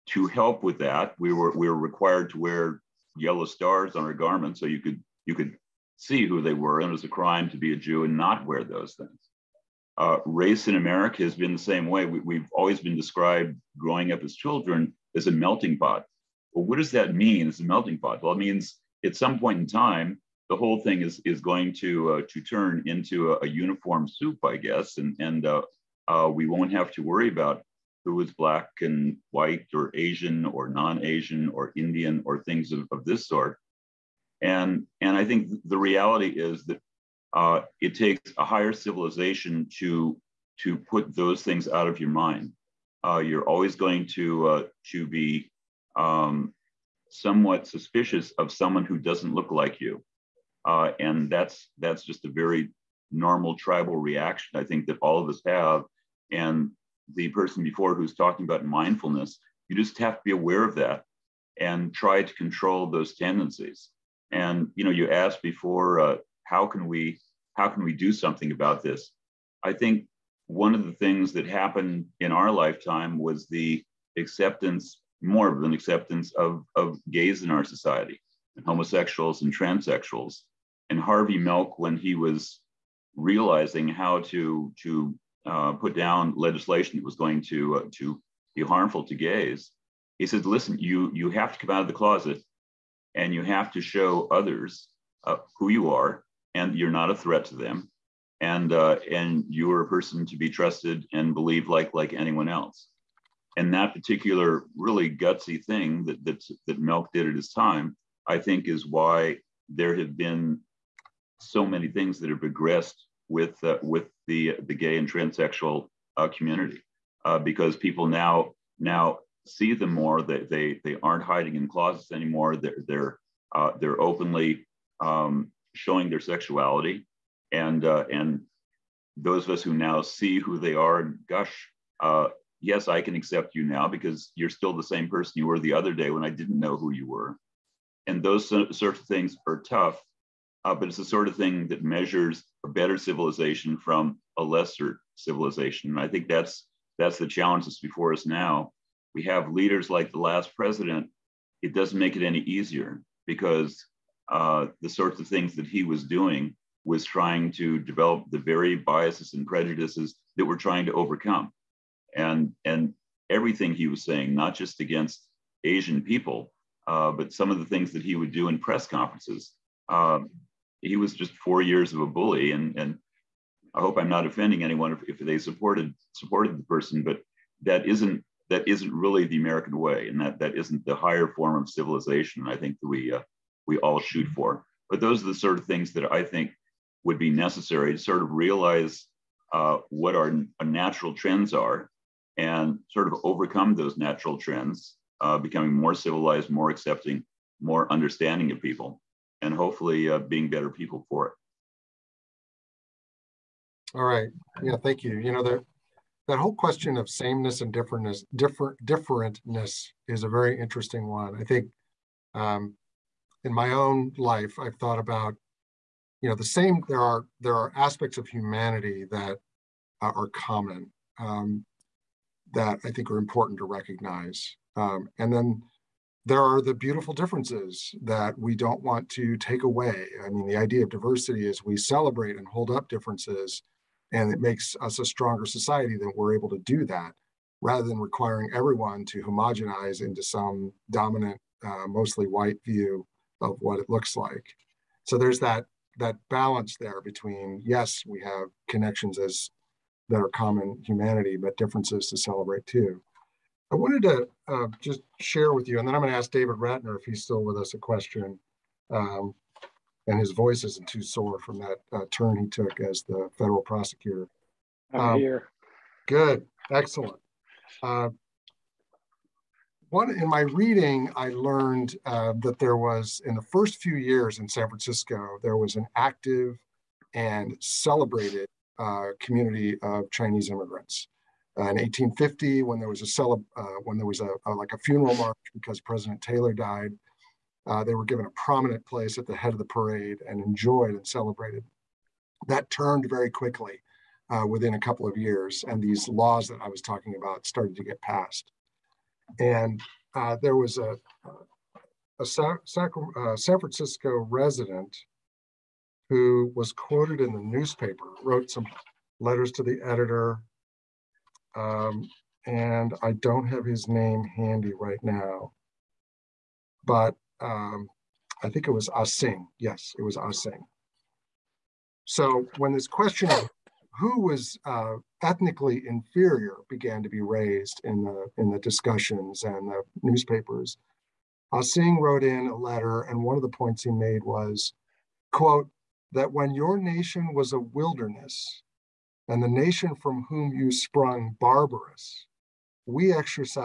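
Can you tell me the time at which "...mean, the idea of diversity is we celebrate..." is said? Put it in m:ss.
3:50.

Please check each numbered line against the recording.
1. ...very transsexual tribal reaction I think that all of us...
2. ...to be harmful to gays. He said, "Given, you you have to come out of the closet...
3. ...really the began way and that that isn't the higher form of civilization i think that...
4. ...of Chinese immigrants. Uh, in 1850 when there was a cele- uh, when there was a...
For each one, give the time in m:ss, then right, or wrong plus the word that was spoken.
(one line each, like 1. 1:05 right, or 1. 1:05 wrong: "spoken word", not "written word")
1. 0:52 wrong: "normal", not "transsexual"
2. 1:27 wrong: "Listen", not "Given"
3. 2:58 wrong: "american", not "began"
4. 4:39 right.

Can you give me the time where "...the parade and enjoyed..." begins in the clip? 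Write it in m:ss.
4:49.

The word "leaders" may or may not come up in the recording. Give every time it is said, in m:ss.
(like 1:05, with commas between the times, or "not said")
2:29.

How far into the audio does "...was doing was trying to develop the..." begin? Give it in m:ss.
2:35.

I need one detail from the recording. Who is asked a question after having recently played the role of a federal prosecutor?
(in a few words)
David Ratner.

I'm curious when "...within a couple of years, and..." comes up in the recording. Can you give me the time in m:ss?
4:54.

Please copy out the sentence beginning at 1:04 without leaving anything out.
And you know, you asked before, uh, how can we how can we do something about this?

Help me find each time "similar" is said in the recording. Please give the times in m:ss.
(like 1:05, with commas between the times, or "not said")
not said.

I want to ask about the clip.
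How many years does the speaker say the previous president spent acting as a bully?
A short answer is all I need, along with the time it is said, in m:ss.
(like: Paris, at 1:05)
4, at 2:51.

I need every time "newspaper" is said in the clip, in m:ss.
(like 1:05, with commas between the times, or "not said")
5:07, 5:30.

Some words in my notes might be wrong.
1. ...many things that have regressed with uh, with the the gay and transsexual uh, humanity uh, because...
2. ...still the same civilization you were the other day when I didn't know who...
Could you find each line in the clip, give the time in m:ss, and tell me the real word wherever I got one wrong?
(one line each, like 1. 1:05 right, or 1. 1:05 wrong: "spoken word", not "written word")
1. 1:51 wrong: "community", not "humanity"
2. 2:14 wrong: "person", not "civilization".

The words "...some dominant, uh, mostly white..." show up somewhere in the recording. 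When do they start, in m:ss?
4:00.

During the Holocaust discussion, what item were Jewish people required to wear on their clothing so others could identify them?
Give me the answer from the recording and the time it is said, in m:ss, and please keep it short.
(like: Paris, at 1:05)
Yellow stars, at 0:03.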